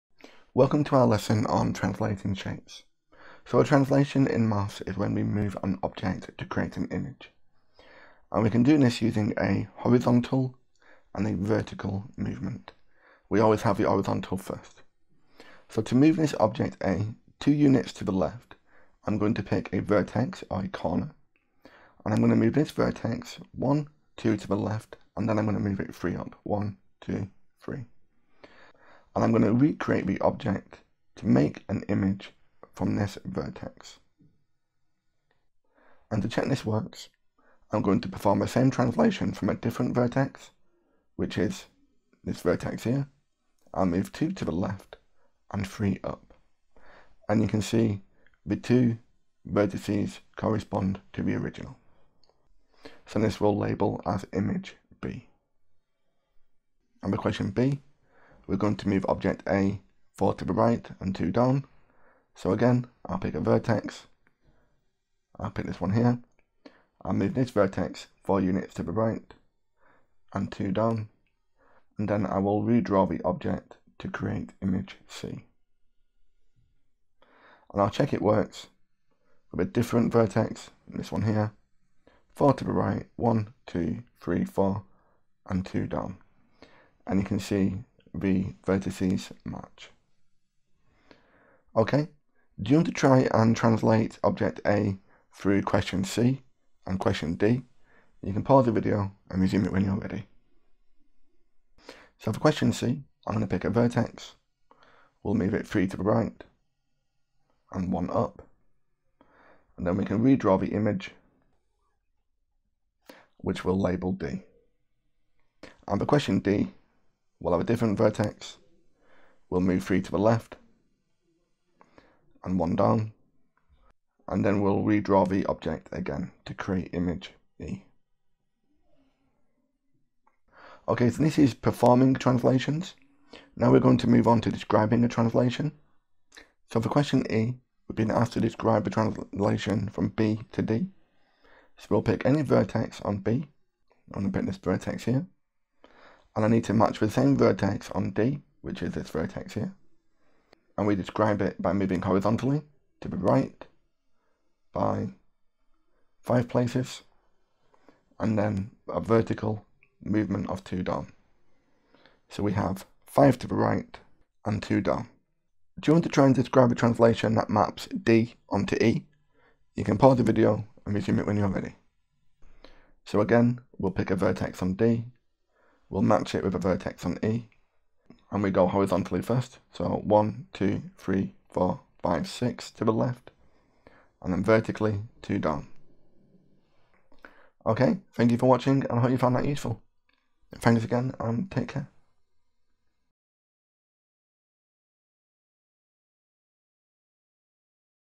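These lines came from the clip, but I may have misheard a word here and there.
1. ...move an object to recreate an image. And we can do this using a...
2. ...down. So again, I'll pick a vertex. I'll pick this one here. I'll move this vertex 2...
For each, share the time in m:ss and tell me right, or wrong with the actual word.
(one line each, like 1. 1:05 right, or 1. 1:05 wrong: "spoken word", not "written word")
1. 0:05 wrong: "create", not "recreate"
2. 1:01 wrong: "4", not "2".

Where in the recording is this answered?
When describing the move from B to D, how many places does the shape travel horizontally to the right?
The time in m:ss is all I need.
2:36.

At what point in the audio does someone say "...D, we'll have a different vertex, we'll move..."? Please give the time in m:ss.
1:56.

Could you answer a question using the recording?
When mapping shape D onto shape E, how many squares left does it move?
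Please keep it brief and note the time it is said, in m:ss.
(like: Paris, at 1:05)
6, at 3:02.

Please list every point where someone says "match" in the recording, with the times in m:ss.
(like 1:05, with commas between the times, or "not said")
1:29, 2:26, 2:56.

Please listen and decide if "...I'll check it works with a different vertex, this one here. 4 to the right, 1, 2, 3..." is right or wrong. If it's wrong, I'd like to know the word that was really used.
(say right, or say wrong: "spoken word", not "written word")
right.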